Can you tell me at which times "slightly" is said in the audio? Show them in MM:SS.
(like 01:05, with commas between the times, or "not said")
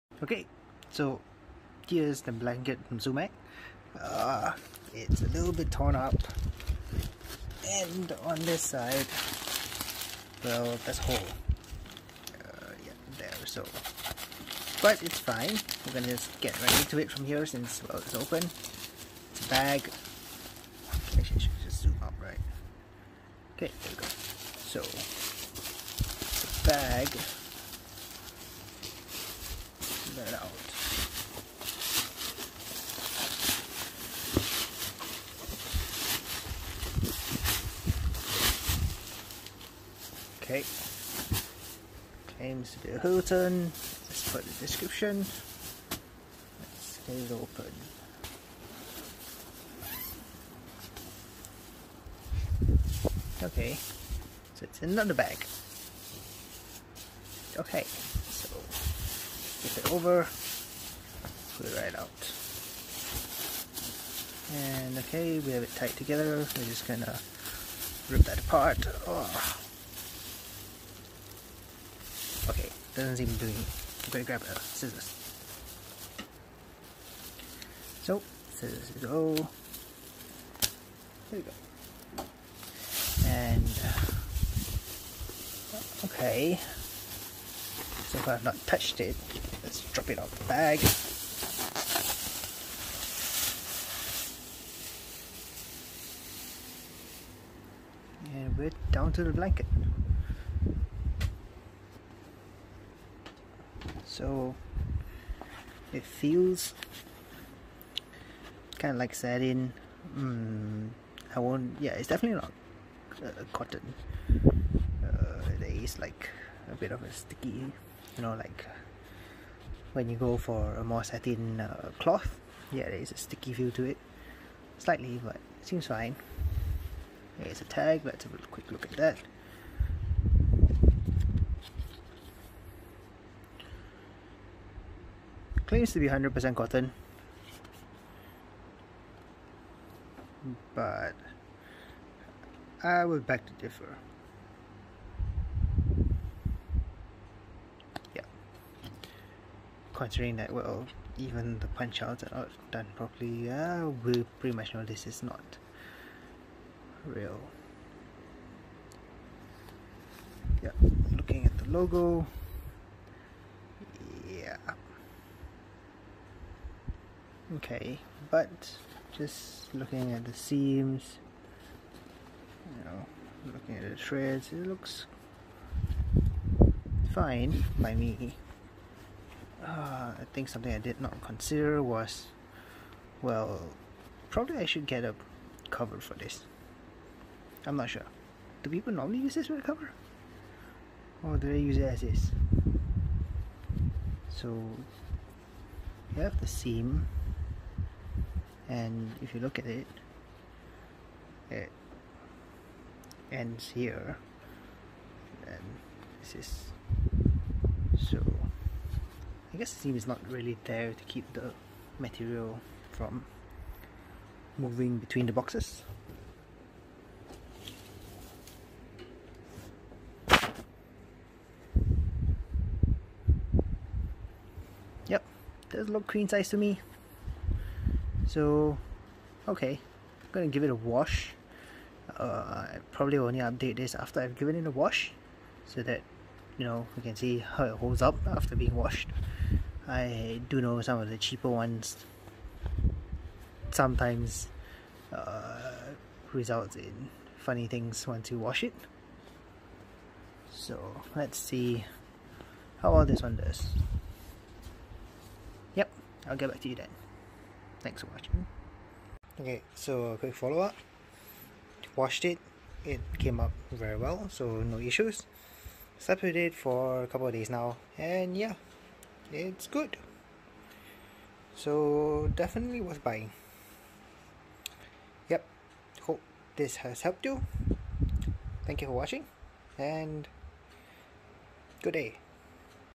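02:04.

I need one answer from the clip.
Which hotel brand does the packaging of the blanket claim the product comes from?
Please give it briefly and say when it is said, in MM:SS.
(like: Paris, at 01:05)
Hilton, at 00:42.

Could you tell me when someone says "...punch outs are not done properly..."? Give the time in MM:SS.
02:31.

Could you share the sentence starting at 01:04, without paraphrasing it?
And okay, we have it tight together.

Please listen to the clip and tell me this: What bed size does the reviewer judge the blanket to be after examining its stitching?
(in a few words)
Queen size.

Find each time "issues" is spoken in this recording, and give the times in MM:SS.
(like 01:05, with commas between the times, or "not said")
04:24.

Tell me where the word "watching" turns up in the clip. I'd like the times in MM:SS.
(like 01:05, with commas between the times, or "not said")
04:18, 04:38.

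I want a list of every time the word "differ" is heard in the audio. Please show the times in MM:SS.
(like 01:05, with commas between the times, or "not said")
02:23.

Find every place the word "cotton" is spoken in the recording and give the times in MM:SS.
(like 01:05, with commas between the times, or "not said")
01:53, 02:16.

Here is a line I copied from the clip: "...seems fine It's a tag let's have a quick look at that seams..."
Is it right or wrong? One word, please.
wrong.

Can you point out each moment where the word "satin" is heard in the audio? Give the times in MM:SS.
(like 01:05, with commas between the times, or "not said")
01:49, 02:01.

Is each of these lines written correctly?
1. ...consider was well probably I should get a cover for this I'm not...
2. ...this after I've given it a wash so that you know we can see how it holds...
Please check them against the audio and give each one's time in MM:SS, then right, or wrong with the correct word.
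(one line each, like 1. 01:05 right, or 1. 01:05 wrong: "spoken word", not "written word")
1. 03:01 right
2. 03:53 right.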